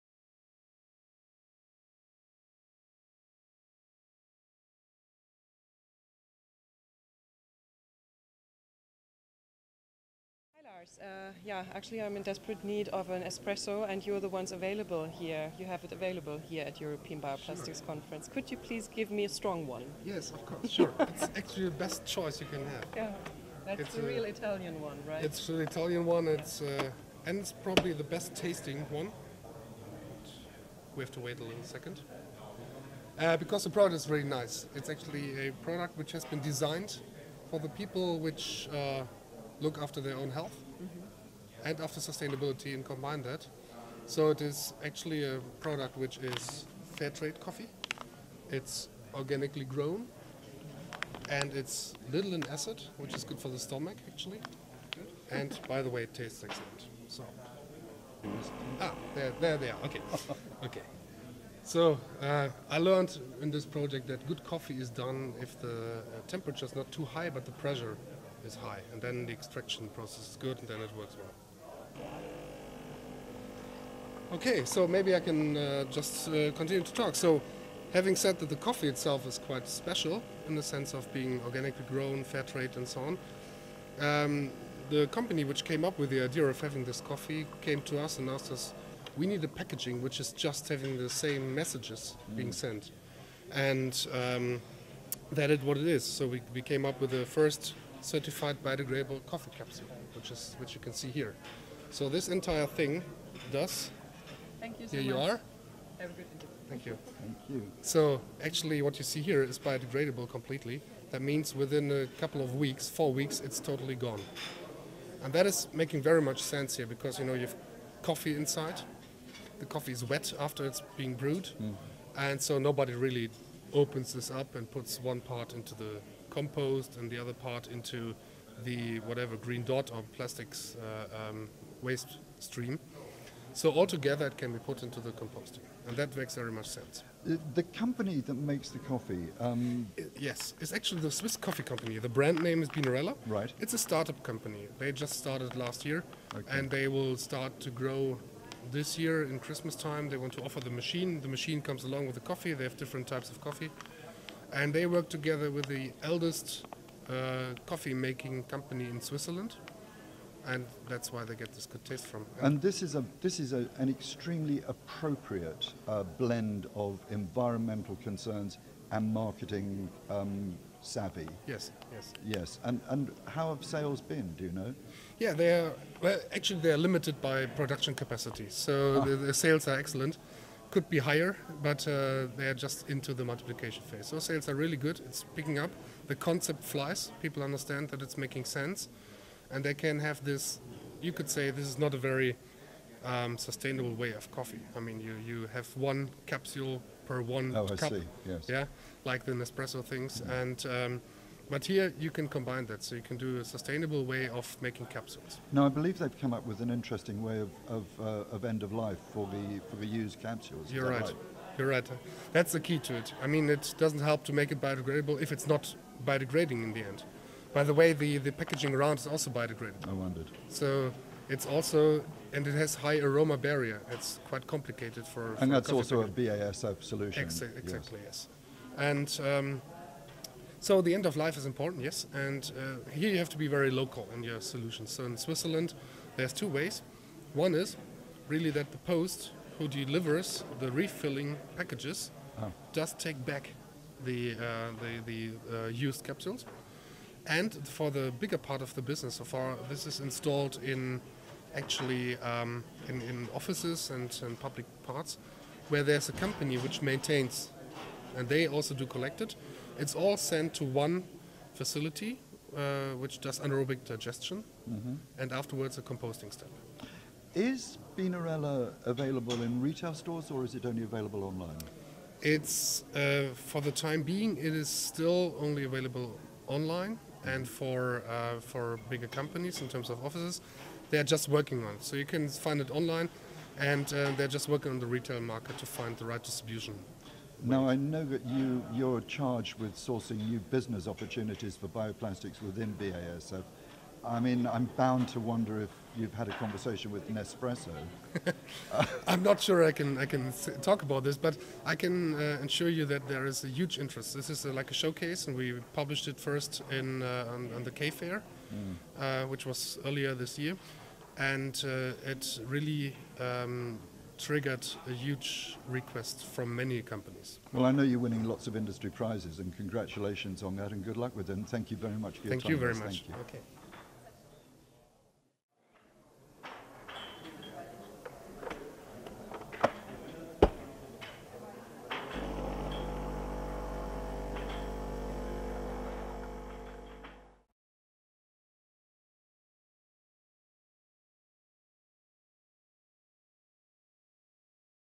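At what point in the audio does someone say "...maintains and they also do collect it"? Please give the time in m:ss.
4:16.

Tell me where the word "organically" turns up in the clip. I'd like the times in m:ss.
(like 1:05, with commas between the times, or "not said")
0:49, 1:21.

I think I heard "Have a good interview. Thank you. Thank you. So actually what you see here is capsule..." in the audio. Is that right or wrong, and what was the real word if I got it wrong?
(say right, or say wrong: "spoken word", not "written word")
wrong: "biodegradable", not "capsule".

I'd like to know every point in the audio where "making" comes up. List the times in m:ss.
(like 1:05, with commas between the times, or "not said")
1:55, 2:37, 3:08, 3:24.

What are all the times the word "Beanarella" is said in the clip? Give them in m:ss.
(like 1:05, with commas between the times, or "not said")
2:22, 4:27.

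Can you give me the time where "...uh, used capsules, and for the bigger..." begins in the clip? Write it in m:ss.
4:05.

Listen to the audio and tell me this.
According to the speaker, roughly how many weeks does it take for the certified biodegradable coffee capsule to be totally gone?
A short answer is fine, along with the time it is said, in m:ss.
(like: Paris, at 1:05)
4 weeks, at 1:52.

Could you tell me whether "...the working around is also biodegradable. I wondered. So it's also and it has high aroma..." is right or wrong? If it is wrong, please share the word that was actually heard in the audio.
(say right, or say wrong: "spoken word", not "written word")
wrong: "packaging", not "working".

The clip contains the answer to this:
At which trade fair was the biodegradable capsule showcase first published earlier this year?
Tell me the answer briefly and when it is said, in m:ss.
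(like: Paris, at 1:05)
K Fair, at 5:07.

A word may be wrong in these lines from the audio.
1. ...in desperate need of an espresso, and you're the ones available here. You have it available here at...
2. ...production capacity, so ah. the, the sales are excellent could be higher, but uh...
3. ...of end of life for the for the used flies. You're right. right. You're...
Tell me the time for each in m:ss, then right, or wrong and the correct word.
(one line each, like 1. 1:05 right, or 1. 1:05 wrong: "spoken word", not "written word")
1. 0:12 right
2. 2:57 right
3. 3:28 wrong: "capsules", not "flies".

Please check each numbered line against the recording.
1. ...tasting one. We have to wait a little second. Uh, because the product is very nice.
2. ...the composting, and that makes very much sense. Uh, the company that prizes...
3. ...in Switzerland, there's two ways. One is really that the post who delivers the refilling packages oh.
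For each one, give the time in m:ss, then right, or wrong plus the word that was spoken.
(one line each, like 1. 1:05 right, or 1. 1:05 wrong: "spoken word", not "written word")
1. 0:28 right
2. 2:15 wrong: "makes", not "prizes"
3. 3:55 right.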